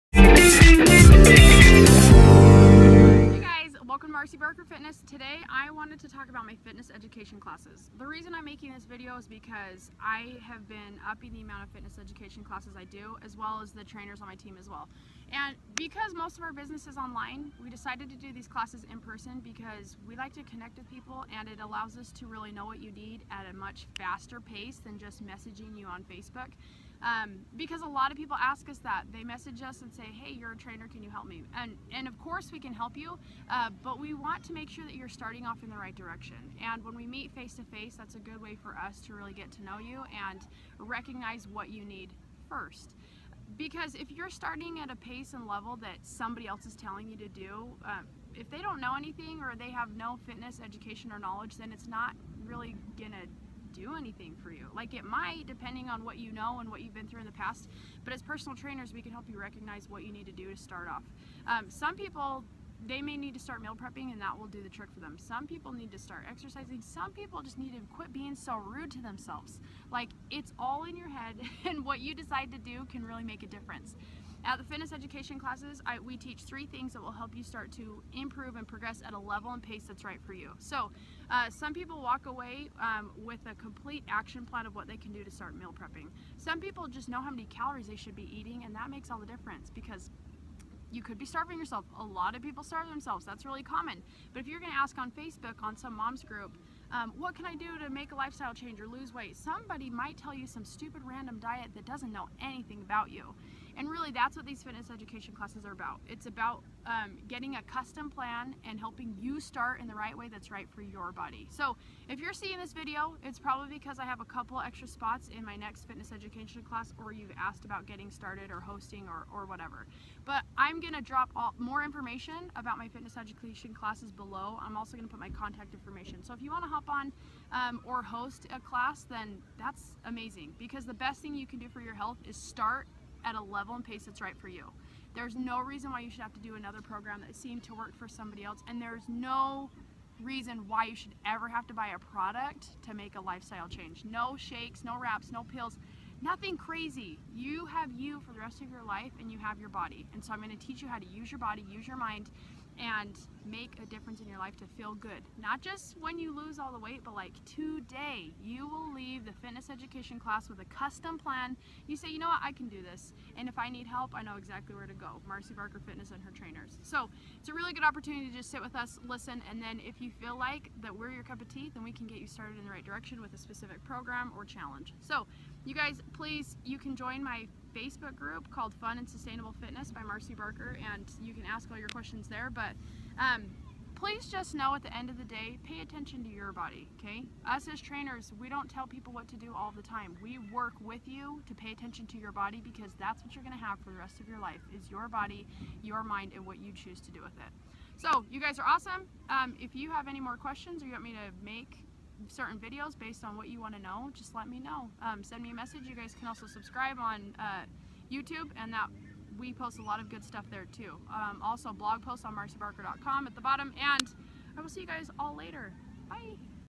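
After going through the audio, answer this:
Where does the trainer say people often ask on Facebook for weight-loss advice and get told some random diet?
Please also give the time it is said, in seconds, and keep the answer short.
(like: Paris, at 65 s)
mom's group, at 95 s.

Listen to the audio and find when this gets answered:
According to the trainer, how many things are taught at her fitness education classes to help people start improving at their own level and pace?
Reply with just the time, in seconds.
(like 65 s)
76 s.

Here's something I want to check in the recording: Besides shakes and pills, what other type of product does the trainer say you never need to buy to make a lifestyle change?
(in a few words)
wraps.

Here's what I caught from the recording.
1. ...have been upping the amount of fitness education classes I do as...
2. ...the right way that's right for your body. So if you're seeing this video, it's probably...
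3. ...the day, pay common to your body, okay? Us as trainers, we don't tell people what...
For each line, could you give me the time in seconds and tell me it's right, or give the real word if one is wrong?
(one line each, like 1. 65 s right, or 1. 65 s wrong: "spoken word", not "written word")
1. 10 s right
2. 109 s right
3. 185 s wrong: "attention", not "common".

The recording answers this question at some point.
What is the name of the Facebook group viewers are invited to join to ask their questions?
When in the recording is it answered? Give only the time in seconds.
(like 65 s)
178 s.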